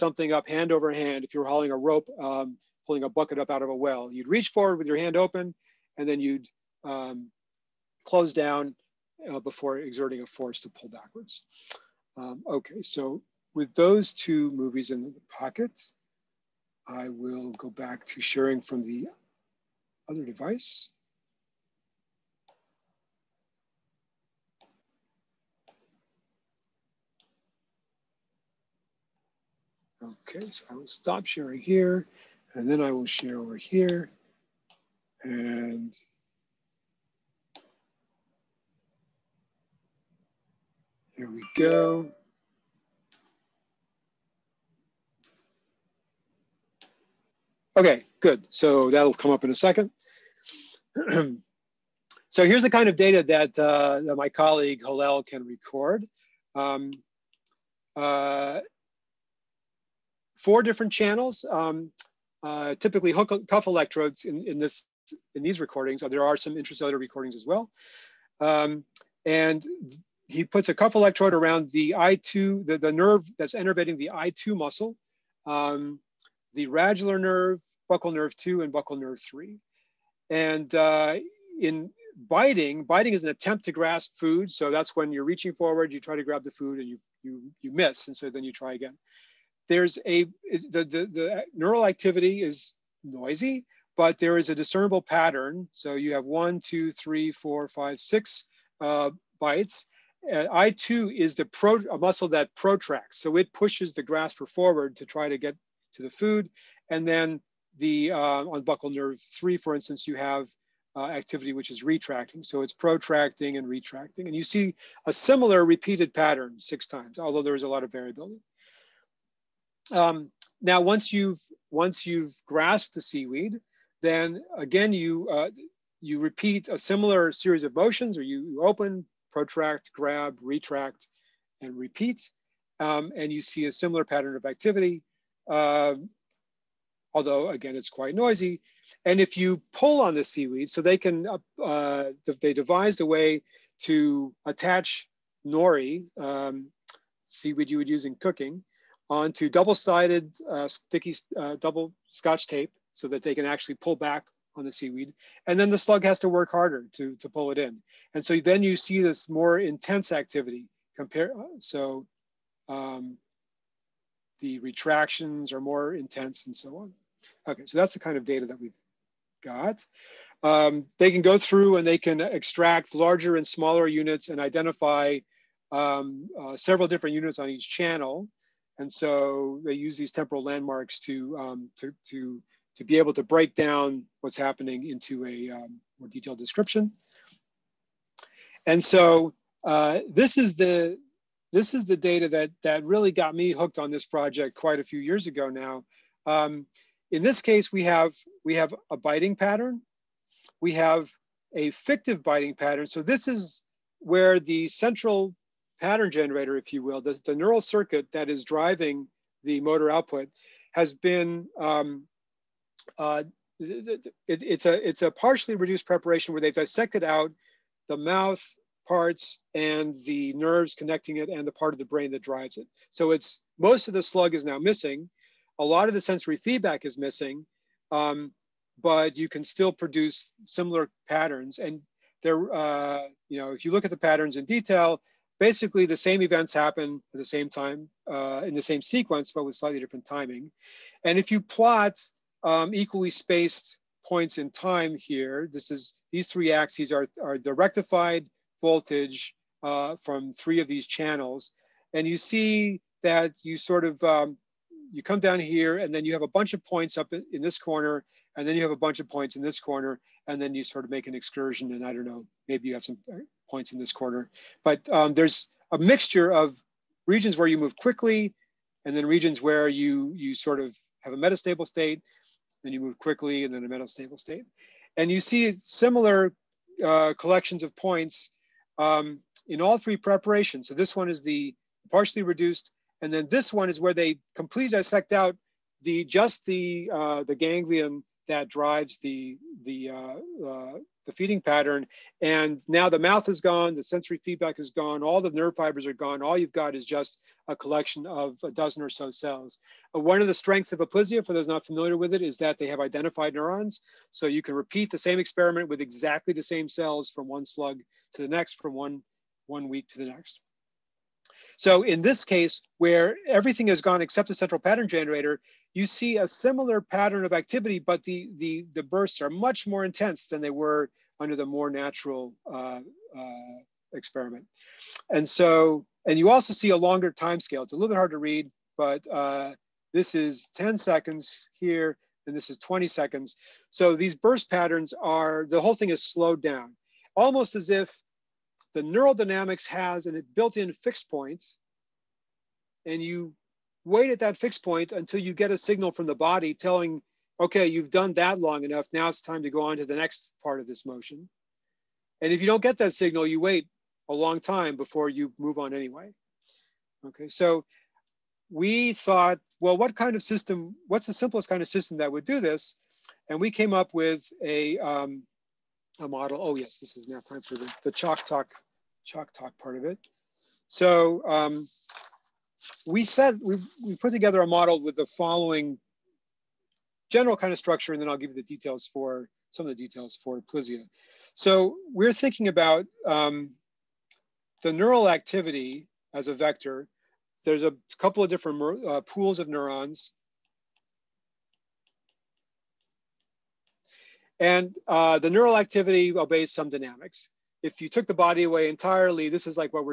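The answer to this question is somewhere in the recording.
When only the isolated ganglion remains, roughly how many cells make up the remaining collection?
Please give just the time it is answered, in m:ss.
4:58.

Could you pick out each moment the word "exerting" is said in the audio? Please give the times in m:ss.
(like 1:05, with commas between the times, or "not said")
0:09.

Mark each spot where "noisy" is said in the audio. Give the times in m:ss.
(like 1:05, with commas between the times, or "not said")
1:33, 2:18.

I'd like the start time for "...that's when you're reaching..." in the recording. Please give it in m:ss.
1:24.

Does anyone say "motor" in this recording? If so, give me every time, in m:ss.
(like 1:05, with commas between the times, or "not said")
3:29.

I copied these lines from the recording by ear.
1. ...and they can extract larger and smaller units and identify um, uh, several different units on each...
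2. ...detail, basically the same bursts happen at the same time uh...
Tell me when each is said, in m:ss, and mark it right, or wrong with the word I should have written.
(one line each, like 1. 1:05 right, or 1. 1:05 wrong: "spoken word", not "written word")
1. 2:51 right
2. 3:54 wrong: "events", not "bursts".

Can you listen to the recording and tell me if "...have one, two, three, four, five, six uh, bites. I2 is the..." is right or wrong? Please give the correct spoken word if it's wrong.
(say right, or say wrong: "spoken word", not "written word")
right.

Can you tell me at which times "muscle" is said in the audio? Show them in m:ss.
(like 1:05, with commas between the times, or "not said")
1:14, 1:41.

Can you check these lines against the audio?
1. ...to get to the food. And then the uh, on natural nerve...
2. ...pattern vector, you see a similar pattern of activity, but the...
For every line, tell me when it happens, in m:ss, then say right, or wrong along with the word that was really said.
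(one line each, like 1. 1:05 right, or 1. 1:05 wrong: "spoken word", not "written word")
1. 1:45 wrong: "buccal", not "natural"
2. 5:14 wrong: "generator", not "vector".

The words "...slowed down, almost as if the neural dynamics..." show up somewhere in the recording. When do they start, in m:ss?
5:36.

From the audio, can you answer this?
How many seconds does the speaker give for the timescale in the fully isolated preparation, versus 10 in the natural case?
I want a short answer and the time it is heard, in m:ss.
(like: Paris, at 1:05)
20, at 5:32.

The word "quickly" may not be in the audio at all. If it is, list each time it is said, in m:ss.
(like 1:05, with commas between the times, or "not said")
4:27, 4:32.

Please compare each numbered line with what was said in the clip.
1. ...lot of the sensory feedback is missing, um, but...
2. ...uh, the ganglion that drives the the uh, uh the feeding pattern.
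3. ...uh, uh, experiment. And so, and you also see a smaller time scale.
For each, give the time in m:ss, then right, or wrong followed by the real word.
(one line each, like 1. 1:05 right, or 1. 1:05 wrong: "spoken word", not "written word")
1. 3:45 right
2. 4:46 right
3. 5:22 wrong: "longer", not "smaller".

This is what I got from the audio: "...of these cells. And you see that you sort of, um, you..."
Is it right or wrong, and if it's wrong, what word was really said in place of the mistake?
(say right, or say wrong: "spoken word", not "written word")
wrong: "channels", not "cells".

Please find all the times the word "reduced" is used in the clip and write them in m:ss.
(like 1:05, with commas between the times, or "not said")
3:35, 4:42.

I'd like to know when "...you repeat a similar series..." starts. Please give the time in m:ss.
2:05.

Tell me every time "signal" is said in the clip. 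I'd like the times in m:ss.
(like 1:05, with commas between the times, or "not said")
5:45, 5:52.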